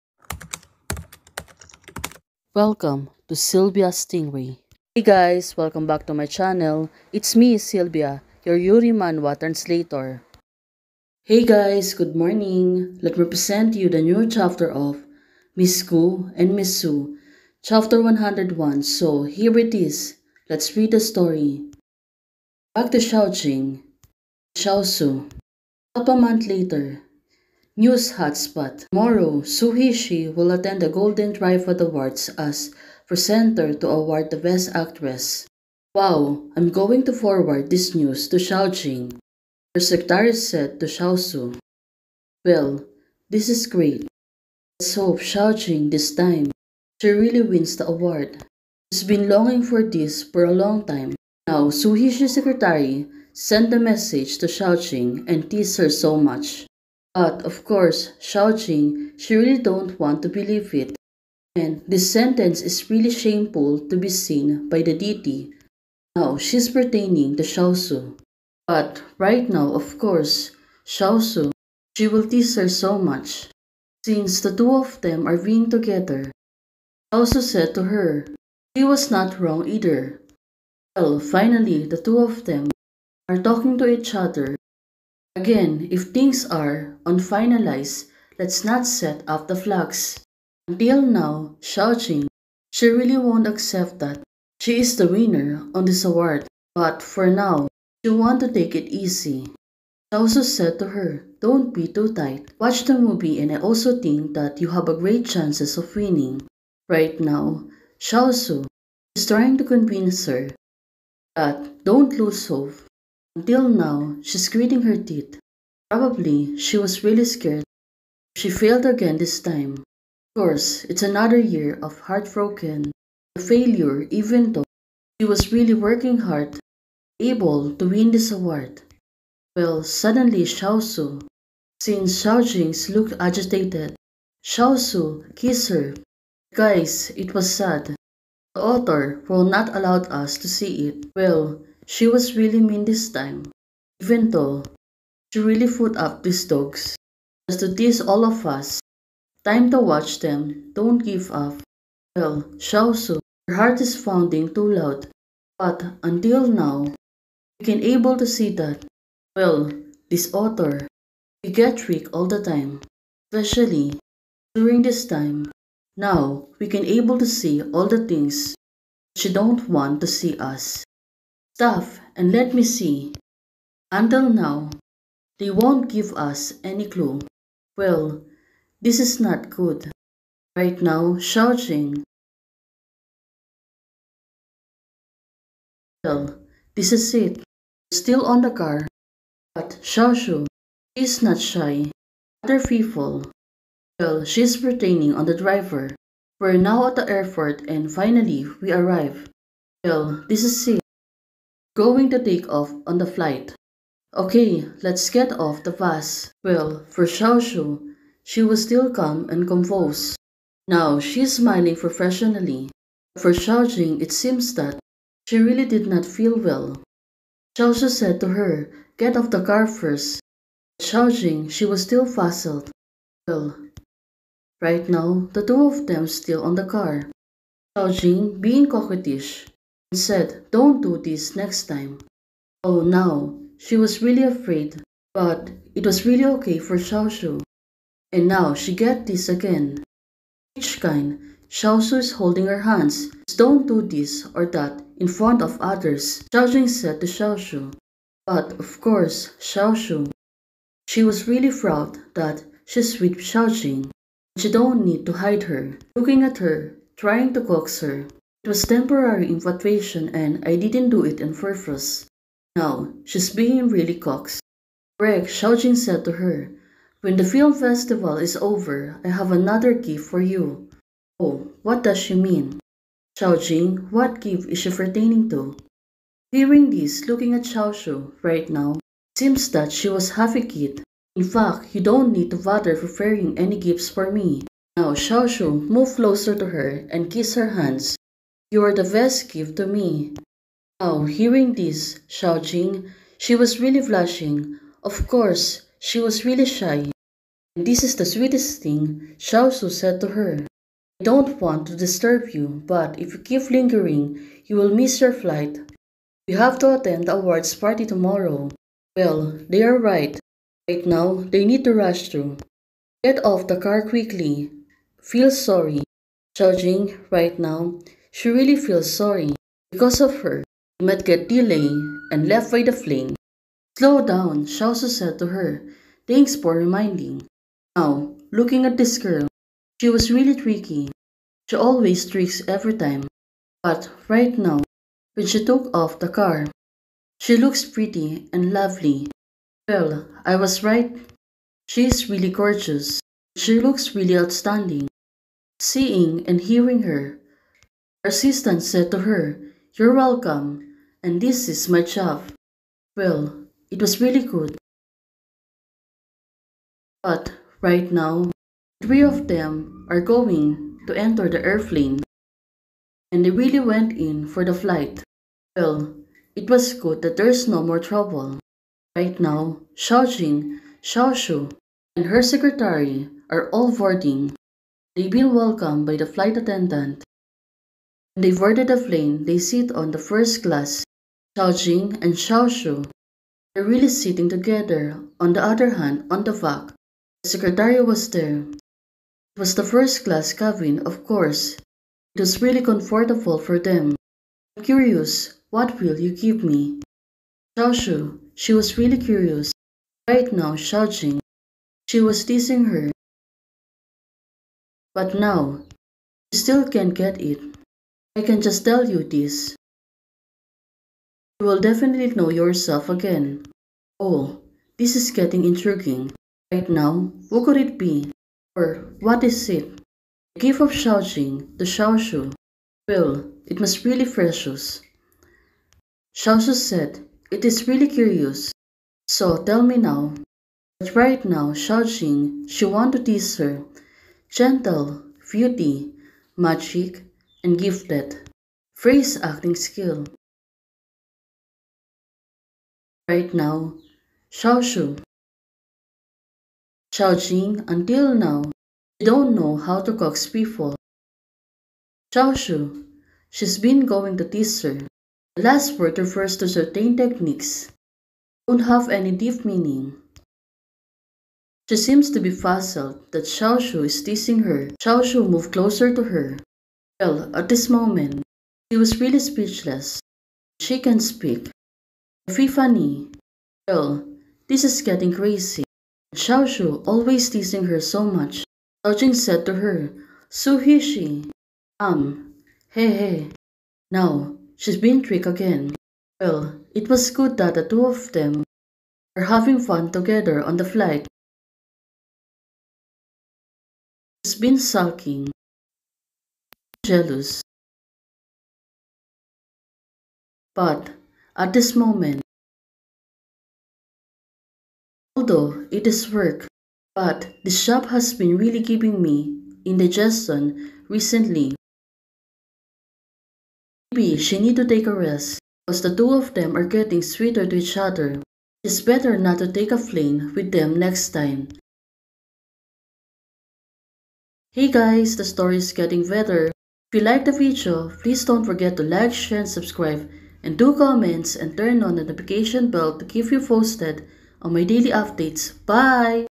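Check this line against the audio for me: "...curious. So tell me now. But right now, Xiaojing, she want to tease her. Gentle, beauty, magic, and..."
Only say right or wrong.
right.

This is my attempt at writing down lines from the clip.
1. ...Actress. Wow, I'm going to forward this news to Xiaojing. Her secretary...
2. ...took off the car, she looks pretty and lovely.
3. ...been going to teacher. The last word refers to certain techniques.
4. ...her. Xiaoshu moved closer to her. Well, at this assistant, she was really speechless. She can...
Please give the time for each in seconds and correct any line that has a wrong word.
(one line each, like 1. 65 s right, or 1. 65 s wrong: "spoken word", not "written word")
1. 34 s right
2. 335 s right
3. 453 s right
4. 464 s wrong: "moment", not "assistant".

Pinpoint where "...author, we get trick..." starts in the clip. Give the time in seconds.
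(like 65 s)
160 s.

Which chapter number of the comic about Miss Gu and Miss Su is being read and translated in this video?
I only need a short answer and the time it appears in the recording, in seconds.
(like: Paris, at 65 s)
101, at 17 s.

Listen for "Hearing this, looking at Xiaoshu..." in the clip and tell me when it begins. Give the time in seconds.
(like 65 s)
276 s.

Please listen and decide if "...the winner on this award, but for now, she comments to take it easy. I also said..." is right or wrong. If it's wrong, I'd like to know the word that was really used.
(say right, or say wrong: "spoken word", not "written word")
wrong: "wants", not "comments".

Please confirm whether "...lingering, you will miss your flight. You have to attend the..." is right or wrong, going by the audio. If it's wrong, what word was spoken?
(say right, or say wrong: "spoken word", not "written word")
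right.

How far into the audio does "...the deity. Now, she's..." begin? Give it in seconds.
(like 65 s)
64 s.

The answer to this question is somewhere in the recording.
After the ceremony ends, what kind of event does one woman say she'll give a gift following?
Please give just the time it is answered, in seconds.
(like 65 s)
267 s.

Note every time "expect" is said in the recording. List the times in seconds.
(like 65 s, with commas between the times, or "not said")
not said.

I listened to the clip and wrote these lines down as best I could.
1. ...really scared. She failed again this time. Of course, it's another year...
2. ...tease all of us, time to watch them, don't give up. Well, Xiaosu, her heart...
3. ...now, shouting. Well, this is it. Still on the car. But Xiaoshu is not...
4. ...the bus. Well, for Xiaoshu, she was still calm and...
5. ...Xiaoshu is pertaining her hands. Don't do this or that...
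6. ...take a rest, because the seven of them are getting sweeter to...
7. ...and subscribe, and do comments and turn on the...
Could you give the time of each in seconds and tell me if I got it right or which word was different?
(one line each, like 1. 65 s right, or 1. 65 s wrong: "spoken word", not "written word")
1. 117 s right
2. 147 s right
3. 180 s right
4. 205 s right
5. 241 s wrong: "holding", not "pertaining"
6. 514 s wrong: "two", not "seven"
7. 529 s right.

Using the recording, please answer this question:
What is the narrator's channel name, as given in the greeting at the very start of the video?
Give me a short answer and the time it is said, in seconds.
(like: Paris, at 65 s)
Sylvia Stingray, at 3 s.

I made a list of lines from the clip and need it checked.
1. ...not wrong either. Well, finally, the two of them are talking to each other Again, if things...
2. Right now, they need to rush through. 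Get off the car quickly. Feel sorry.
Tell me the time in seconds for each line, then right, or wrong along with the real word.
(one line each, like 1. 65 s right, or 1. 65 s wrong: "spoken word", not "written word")
1. 79 s right
2. 310 s right.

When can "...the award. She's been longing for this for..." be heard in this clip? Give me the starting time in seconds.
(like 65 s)
47 s.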